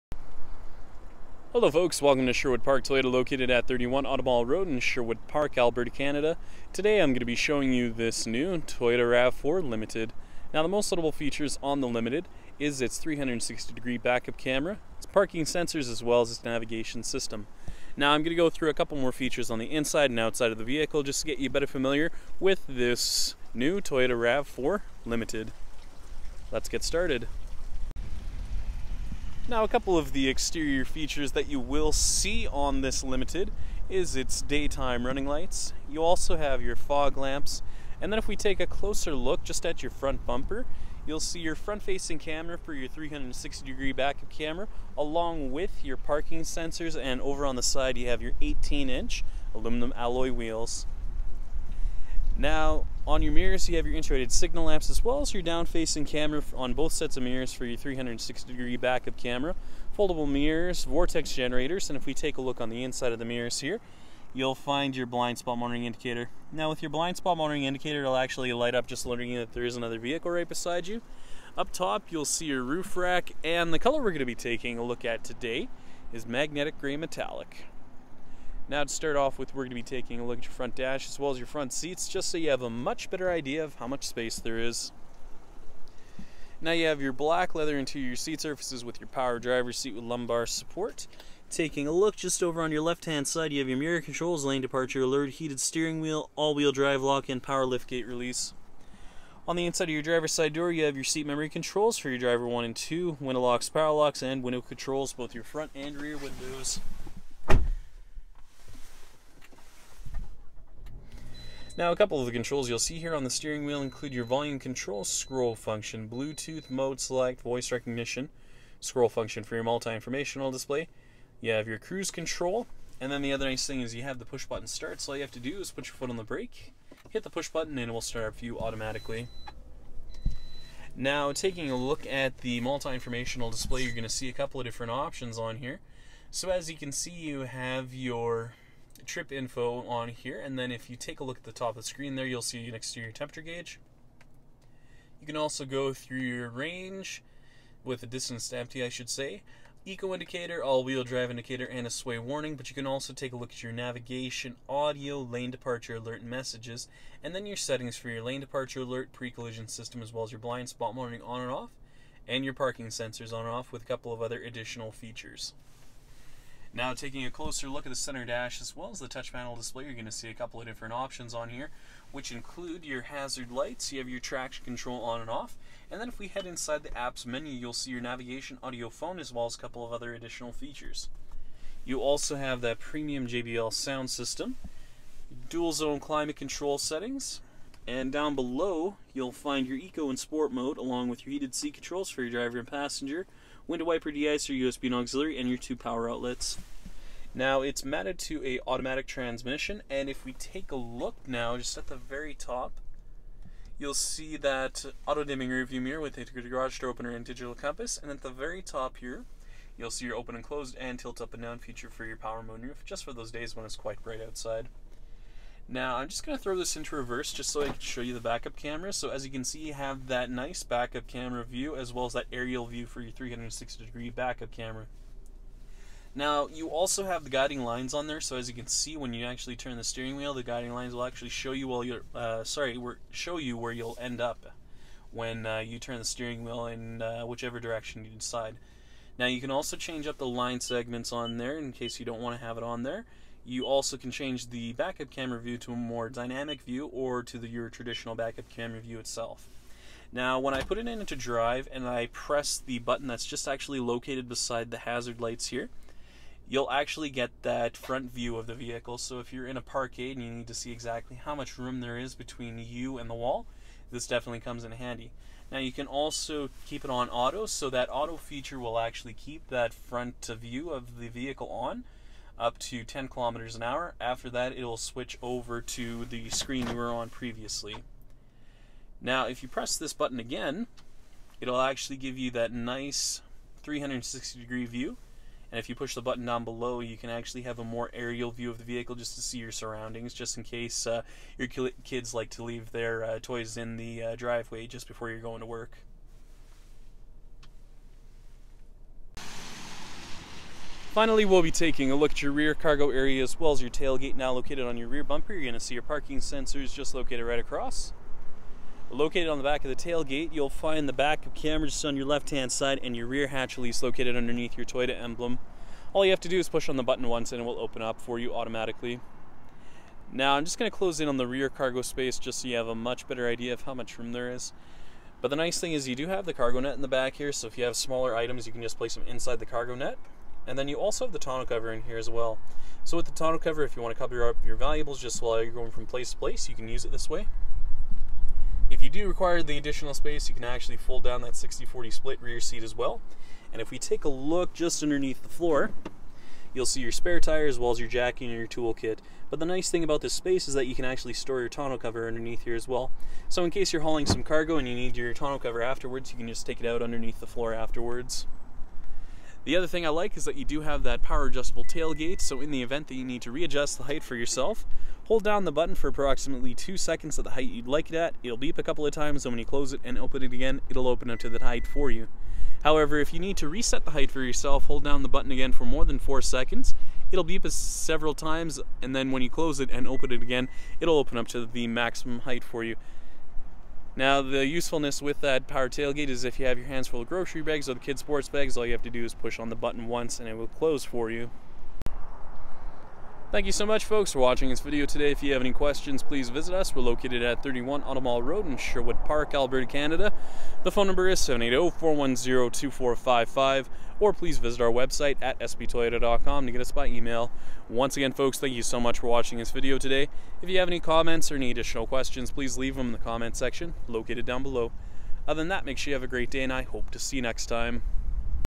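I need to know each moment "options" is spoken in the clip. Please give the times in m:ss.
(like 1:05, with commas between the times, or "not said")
2:14, 2:50.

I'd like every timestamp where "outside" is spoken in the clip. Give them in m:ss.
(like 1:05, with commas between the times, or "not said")
0:20, 3:34.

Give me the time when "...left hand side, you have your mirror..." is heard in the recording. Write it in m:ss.
1:32.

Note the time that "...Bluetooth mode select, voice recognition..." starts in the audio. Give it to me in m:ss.
1:56.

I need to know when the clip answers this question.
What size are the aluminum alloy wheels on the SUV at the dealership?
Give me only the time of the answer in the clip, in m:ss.
0:48.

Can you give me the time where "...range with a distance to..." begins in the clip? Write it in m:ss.
2:26.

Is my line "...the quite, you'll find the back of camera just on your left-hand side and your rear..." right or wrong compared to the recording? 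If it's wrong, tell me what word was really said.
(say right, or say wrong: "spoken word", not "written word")
wrong: "tailgate", not "quite".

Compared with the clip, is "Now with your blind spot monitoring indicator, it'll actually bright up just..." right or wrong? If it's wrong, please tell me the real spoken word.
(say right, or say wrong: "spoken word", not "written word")
wrong: "light", not "bright".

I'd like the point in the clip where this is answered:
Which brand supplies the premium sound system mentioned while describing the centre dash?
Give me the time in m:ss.
3:03.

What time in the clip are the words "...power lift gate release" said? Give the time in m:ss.
1:37.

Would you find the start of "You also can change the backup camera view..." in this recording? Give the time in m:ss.
4:03.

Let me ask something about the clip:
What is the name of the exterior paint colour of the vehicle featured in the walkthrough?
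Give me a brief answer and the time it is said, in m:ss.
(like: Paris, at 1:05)
Magnetic gray metallic, at 1:16.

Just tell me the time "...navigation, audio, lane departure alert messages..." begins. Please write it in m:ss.
2:33.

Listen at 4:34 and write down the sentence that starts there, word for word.
After that, it'll switch over to the screen you were on previously.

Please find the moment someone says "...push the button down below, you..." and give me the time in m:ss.
4:45.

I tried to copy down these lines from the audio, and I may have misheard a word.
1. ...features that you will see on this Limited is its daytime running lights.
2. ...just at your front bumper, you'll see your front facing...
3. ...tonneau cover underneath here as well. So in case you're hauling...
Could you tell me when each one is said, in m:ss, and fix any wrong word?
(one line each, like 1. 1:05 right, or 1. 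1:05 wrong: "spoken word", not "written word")
1. 0:30 right
2. 0:39 right
3. 5:51 right.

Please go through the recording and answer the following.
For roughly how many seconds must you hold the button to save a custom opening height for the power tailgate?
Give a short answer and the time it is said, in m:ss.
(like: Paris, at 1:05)
2 seconds, at 6:06.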